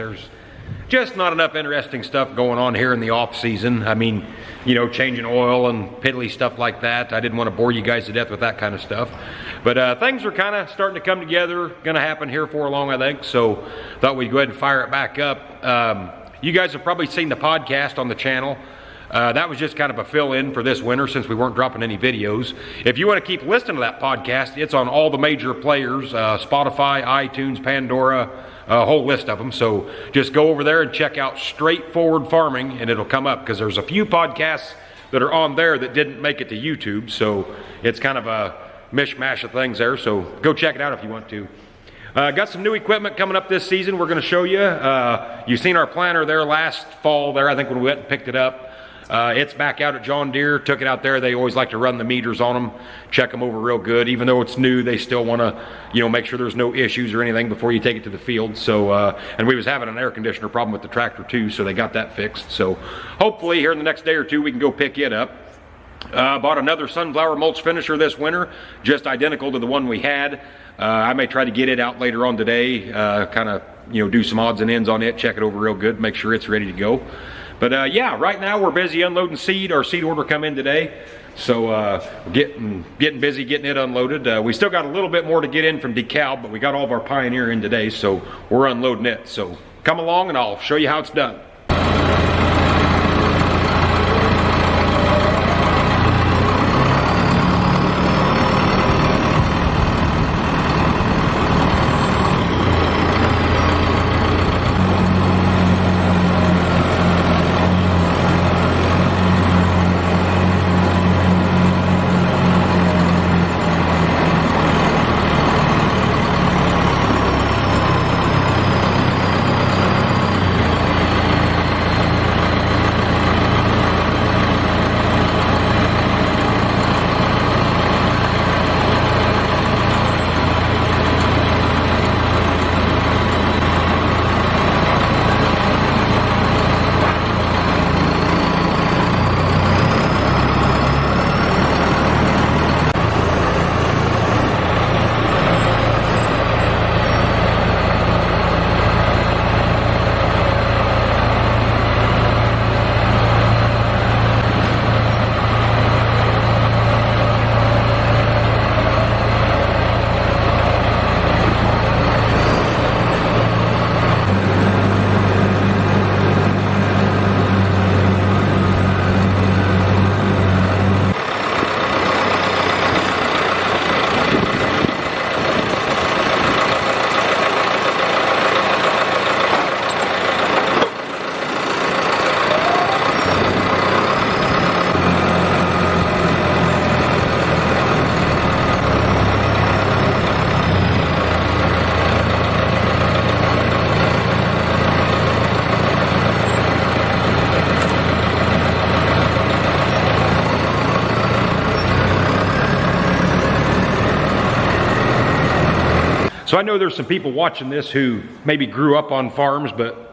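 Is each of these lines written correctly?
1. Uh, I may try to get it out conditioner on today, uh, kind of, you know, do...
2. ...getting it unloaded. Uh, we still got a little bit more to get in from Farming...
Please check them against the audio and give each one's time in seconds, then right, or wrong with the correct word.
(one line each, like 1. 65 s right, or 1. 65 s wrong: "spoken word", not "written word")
1. 70 s wrong: "later", not "conditioner"
2. 83 s wrong: "DeKalb", not "Farming".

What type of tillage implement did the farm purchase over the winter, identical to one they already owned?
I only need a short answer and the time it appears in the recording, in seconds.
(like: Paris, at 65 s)
Mulch finisher, at 67 s.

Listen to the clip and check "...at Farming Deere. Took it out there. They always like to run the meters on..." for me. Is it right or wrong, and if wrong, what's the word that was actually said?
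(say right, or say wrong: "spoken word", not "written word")
wrong: "John", not "Farming".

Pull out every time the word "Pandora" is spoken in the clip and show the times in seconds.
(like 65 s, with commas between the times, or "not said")
27 s.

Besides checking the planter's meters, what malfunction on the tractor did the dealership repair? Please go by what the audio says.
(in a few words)
Air conditioner.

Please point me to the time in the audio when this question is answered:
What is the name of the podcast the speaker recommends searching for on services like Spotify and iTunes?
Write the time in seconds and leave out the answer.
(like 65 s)
31 s.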